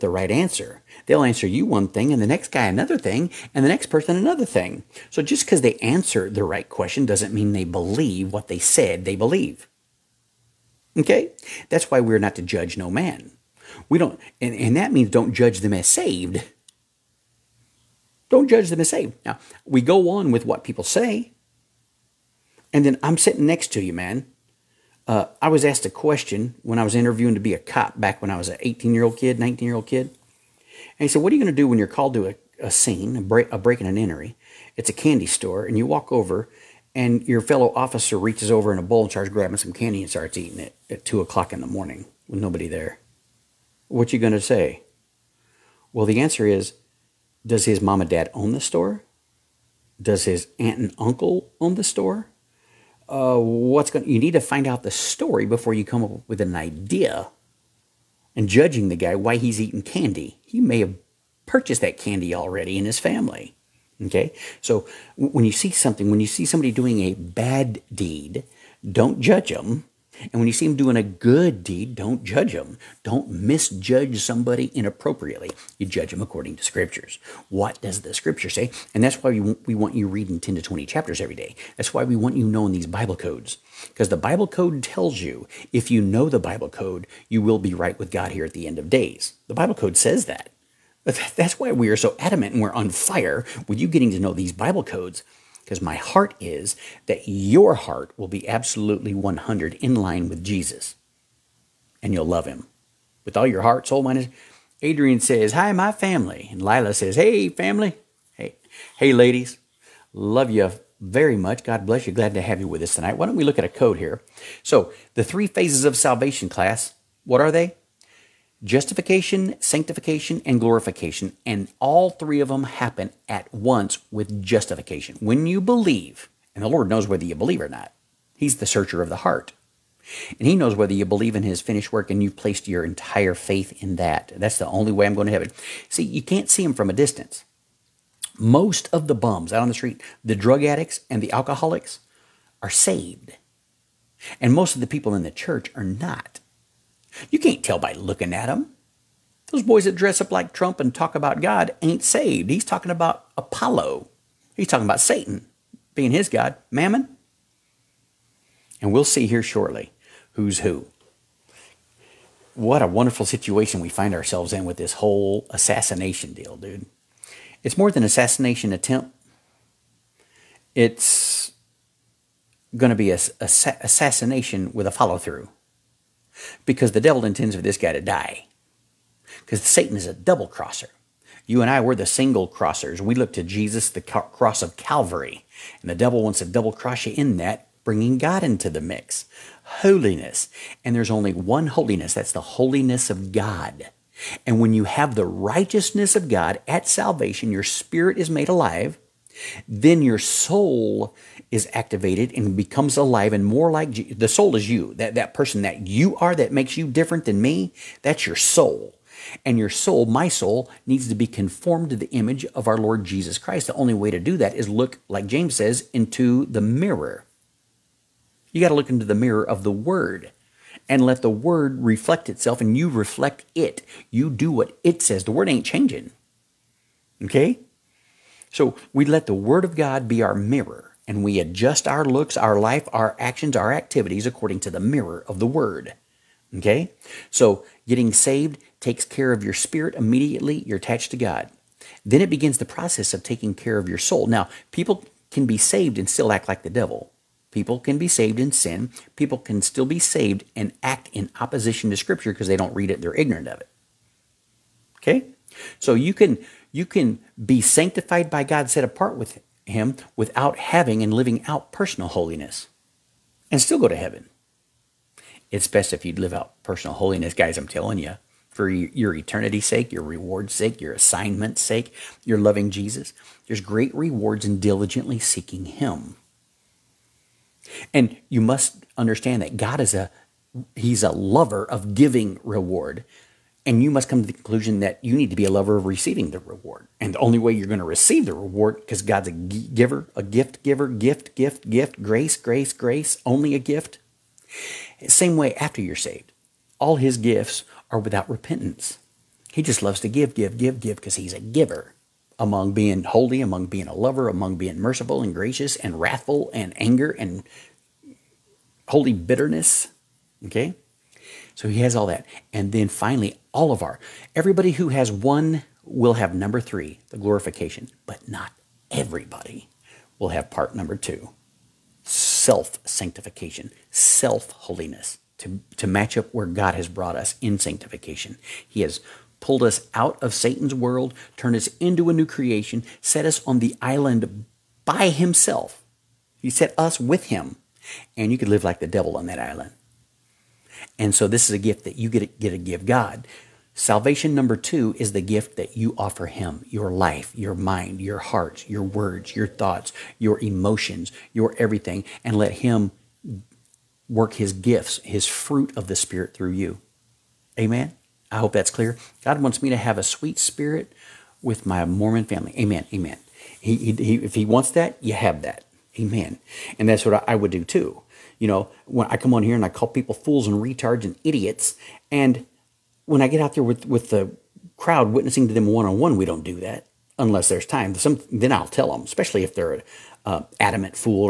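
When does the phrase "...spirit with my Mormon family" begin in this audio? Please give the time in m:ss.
6:00.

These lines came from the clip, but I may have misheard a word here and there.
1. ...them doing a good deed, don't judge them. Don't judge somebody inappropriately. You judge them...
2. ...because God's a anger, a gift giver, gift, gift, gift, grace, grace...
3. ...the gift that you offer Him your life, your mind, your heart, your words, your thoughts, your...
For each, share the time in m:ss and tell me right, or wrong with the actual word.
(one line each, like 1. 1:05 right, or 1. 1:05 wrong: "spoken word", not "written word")
1. 1:10 wrong: "misjudge", not "judge"
2. 4:48 wrong: "giver", not "anger"
3. 5:45 right.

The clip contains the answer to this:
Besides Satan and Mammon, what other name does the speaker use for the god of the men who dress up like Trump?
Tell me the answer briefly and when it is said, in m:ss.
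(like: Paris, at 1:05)
Apollo, at 2:33.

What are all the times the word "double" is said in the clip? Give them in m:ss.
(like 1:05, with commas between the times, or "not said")
3:00, 3:06.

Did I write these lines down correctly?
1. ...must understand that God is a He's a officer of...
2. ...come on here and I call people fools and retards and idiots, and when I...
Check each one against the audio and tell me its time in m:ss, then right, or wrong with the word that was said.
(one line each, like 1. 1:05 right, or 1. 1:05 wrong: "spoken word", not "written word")
1. 4:38 wrong: "lover", not "officer"
2. 6:09 right.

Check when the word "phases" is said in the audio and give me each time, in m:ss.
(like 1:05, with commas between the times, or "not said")
1:55.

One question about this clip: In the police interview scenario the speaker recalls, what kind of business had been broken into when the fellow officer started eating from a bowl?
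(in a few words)
Candy store.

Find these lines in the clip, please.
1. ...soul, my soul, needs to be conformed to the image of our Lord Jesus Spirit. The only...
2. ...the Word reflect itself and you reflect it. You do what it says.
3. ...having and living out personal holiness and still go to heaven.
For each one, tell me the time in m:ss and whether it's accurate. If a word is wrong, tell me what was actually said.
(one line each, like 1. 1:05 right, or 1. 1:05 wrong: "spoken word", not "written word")
1. 3:29 wrong: "Christ", not "Spirit"
2. 3:41 right
3. 4:20 right.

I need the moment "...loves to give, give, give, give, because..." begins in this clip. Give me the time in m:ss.
4:59.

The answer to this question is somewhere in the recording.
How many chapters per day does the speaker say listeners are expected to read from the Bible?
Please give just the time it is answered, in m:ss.
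1:20.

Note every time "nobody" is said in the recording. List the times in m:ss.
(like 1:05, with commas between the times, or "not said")
0:42.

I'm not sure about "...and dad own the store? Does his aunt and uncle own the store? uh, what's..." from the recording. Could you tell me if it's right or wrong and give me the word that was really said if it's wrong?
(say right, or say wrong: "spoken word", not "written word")
right.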